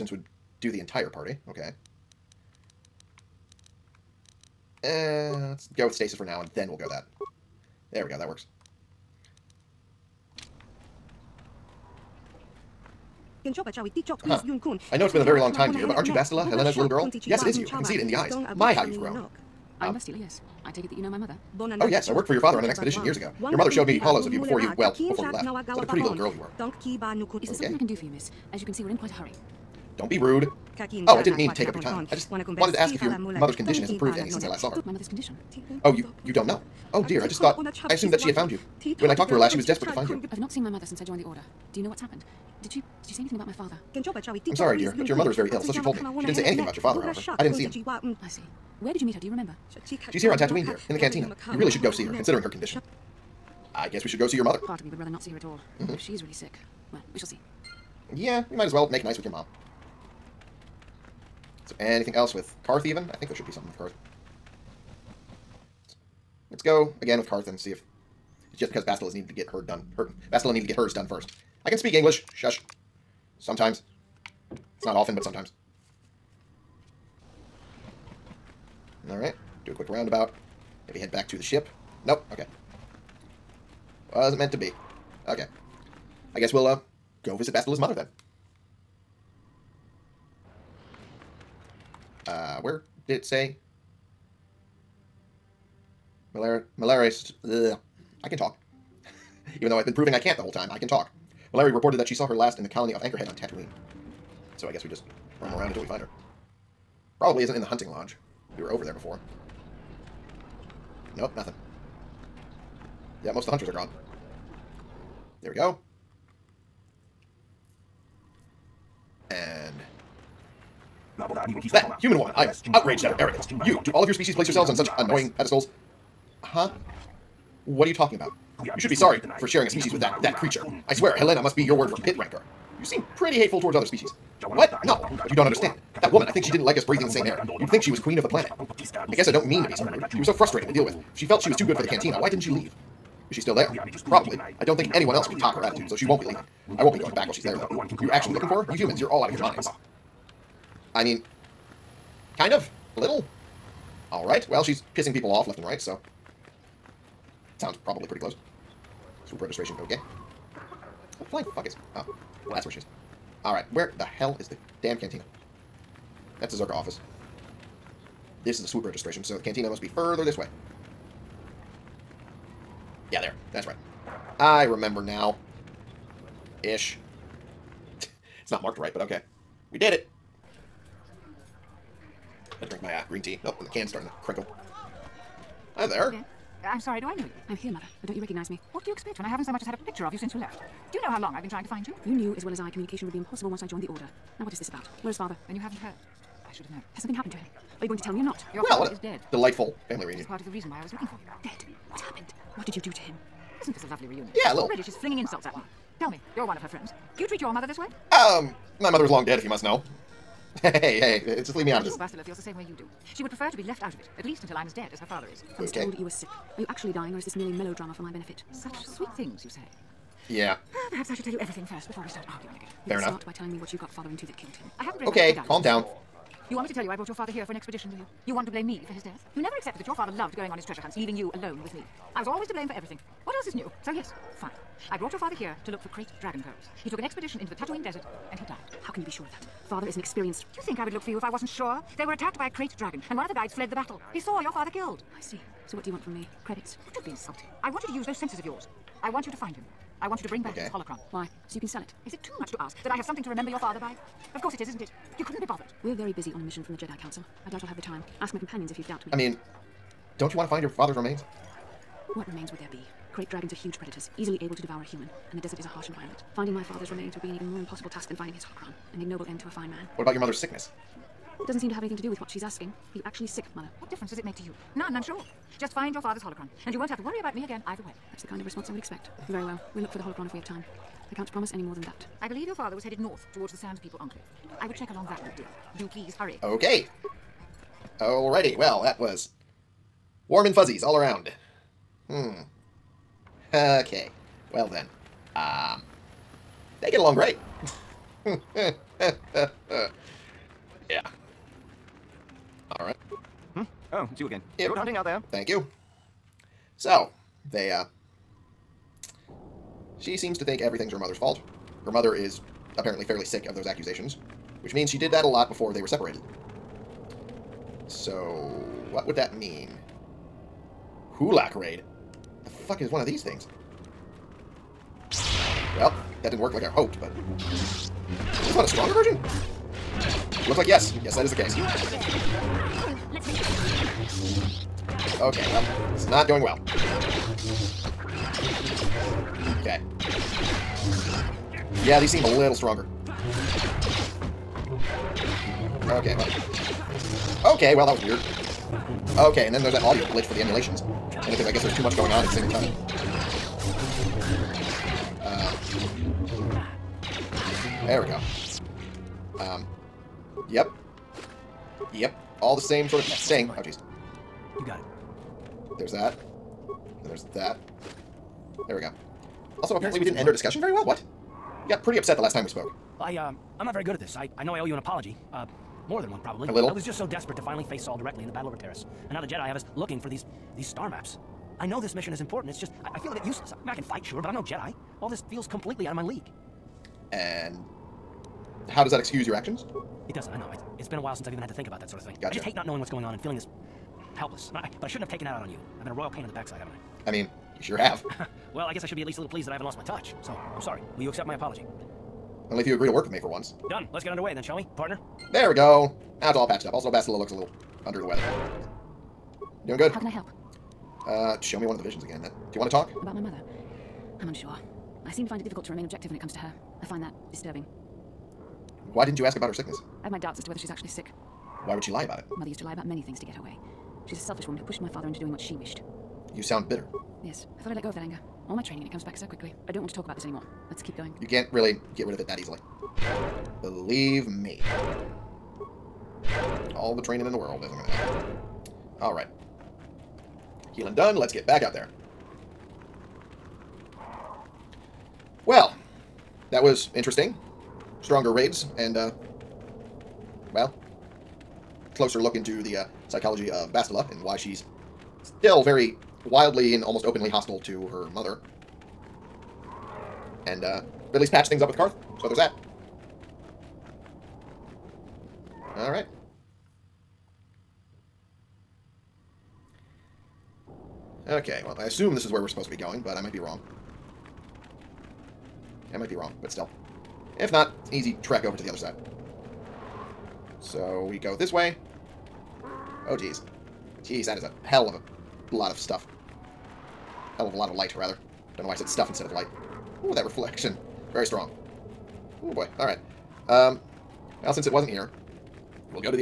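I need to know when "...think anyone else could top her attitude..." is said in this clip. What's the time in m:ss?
2:24.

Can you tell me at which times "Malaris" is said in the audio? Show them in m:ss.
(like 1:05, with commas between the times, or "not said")
1:36, 1:41.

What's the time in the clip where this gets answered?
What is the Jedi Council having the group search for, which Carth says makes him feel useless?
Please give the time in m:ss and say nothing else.
6:20.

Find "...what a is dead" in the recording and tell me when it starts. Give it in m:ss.
3:18.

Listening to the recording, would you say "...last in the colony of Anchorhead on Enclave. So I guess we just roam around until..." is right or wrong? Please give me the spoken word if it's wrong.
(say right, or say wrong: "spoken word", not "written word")
wrong: "Tatooine", not "Enclave".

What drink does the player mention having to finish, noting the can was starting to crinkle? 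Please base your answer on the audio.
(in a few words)
green tea.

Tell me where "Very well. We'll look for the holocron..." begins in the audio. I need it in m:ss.
4:39.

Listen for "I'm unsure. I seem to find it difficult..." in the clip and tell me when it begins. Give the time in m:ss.
6:54.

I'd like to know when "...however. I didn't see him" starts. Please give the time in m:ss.
0:47.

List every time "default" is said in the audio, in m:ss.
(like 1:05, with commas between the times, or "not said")
not said.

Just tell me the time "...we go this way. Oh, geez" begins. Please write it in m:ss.
8:01.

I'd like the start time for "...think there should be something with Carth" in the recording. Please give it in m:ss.
1:03.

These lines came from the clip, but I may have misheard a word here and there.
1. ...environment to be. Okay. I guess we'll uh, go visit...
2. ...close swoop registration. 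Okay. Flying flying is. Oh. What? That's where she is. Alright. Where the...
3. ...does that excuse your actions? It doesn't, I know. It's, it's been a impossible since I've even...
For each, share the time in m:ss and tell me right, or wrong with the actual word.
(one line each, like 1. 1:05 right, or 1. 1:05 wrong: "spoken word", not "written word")
1. 1:24 wrong: "meant", not "environment"
2. 2:38 right
3. 6:28 wrong: "while", not "impossible".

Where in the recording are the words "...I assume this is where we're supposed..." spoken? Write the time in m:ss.
7:51.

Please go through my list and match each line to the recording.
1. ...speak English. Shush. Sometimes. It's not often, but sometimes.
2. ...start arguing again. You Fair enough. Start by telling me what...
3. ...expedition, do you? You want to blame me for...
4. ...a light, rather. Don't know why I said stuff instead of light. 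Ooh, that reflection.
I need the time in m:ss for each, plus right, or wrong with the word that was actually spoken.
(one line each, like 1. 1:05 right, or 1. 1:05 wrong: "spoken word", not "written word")
1. 1:11 right
2. 3:42 right
3. 3:47 right
4. 8:07 right.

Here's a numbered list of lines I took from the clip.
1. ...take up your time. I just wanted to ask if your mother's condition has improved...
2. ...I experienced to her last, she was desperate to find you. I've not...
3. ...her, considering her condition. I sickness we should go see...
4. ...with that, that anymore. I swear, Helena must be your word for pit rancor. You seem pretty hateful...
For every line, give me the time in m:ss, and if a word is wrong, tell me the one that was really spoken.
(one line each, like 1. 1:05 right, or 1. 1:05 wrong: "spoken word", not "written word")
1. 0:31 right
2. 0:39 wrong: "talked", not "experienced"
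3. 0:52 wrong: "guess", not "sickness"
4. 2:09 wrong: "creature", not "anymore".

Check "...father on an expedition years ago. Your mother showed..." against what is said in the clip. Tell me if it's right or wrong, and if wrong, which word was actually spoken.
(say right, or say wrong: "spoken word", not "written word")
right.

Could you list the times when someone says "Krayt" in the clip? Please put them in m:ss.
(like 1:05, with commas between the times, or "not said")
3:55, 4:02, 4:23.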